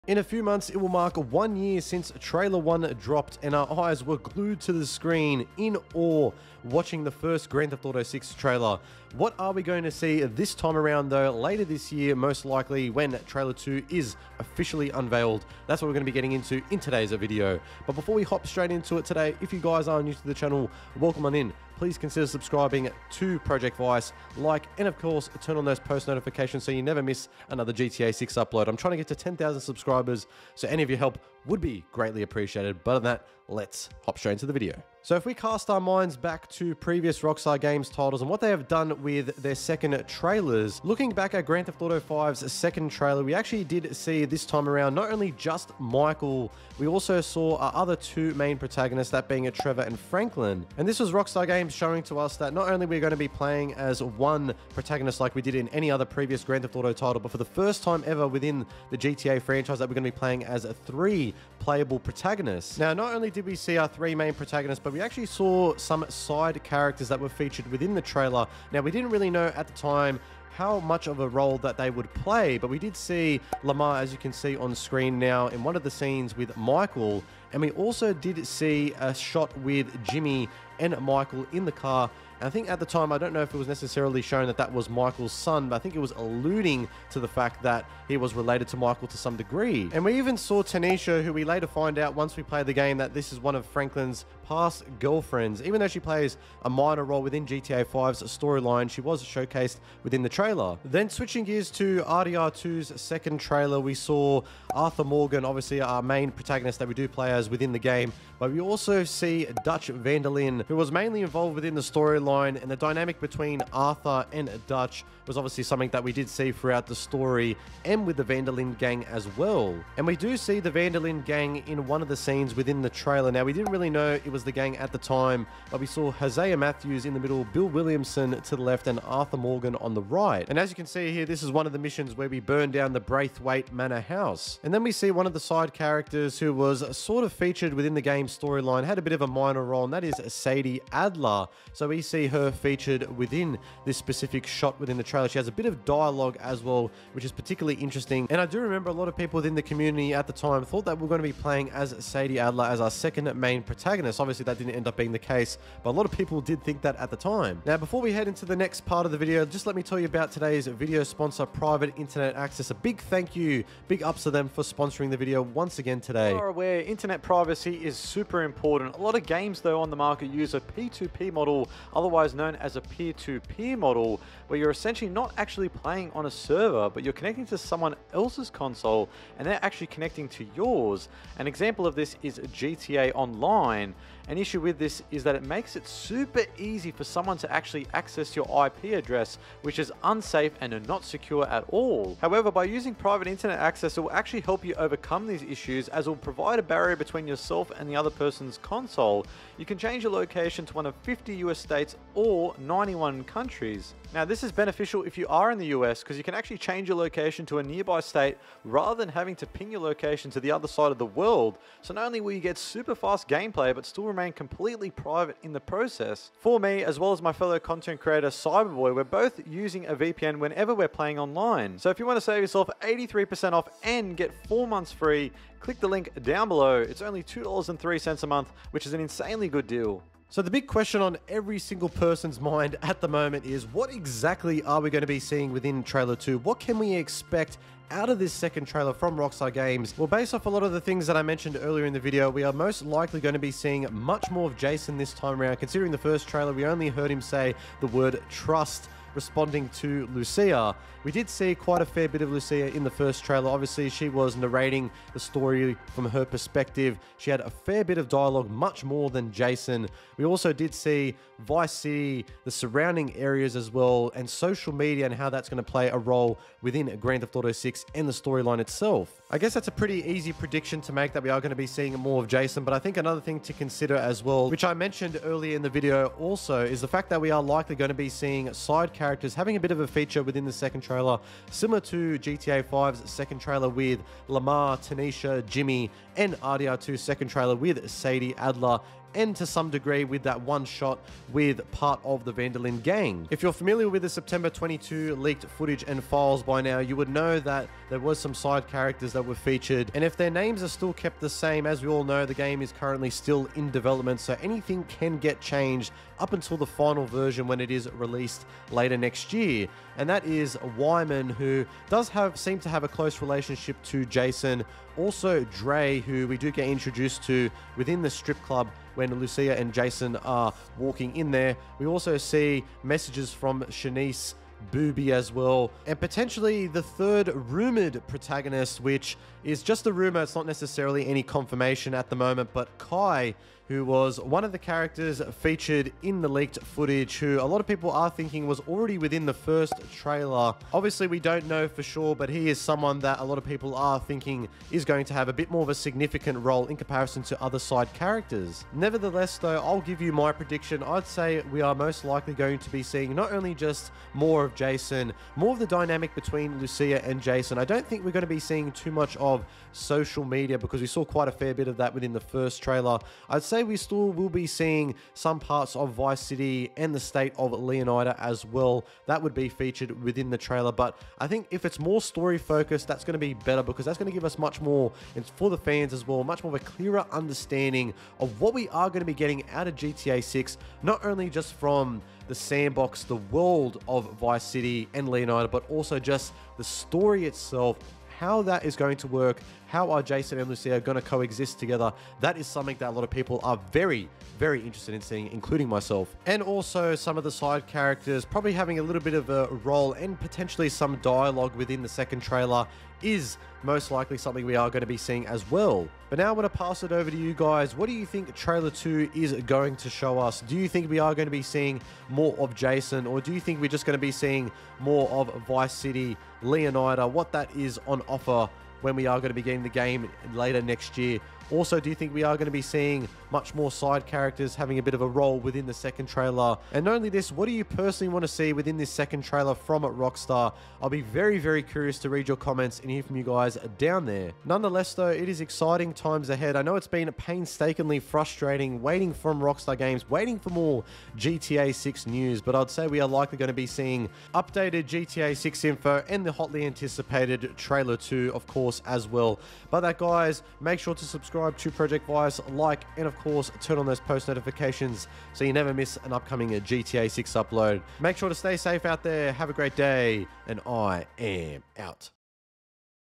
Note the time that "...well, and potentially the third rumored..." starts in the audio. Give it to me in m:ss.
5:25.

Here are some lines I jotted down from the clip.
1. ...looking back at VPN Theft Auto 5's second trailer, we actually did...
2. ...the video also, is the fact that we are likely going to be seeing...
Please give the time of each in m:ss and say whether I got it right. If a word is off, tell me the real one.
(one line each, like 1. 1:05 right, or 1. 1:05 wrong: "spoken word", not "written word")
1. 0:40 wrong: "Grand", not "VPN"
2. 4:35 right.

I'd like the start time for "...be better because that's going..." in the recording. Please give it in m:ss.
6:13.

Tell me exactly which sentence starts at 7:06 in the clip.
And not only this, what do you personally want to see within this second trailer from Rockstar?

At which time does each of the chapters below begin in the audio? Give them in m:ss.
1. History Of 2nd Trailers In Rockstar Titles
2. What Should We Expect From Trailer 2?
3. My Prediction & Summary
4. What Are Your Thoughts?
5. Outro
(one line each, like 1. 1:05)
1. 0:35
2. 3:50
3. 5:49
4. 6:46
5. 7:29.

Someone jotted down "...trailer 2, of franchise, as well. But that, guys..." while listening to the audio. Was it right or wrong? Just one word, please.
wrong.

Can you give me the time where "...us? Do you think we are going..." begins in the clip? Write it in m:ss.
6:50.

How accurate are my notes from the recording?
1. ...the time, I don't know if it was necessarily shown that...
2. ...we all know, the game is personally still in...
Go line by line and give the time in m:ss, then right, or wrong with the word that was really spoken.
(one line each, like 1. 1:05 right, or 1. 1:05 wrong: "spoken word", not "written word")
1. 1:22 right
2. 5:01 wrong: "currently", not "personally".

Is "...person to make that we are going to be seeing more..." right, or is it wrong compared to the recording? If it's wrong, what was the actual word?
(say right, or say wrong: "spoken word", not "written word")
wrong: "prediction", not "person".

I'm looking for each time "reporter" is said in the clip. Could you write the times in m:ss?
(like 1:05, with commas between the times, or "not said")
not said.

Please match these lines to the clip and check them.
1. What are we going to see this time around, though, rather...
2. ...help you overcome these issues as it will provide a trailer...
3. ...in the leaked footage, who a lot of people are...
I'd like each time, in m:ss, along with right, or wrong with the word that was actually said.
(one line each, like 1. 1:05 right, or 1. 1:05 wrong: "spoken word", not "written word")
1. 0:09 wrong: "later", not "rather"
2. 3:14 wrong: "barrier", not "trailer"
3. 5:36 right.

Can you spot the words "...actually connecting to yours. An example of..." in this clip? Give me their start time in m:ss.
2:59.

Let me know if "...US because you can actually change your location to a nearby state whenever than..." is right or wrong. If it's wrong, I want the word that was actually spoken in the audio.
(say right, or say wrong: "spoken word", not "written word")
wrong: "rather", not "whenever".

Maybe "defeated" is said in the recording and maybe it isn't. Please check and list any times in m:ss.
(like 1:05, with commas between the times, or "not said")
not said.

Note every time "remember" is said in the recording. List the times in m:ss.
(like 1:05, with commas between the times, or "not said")
2:28.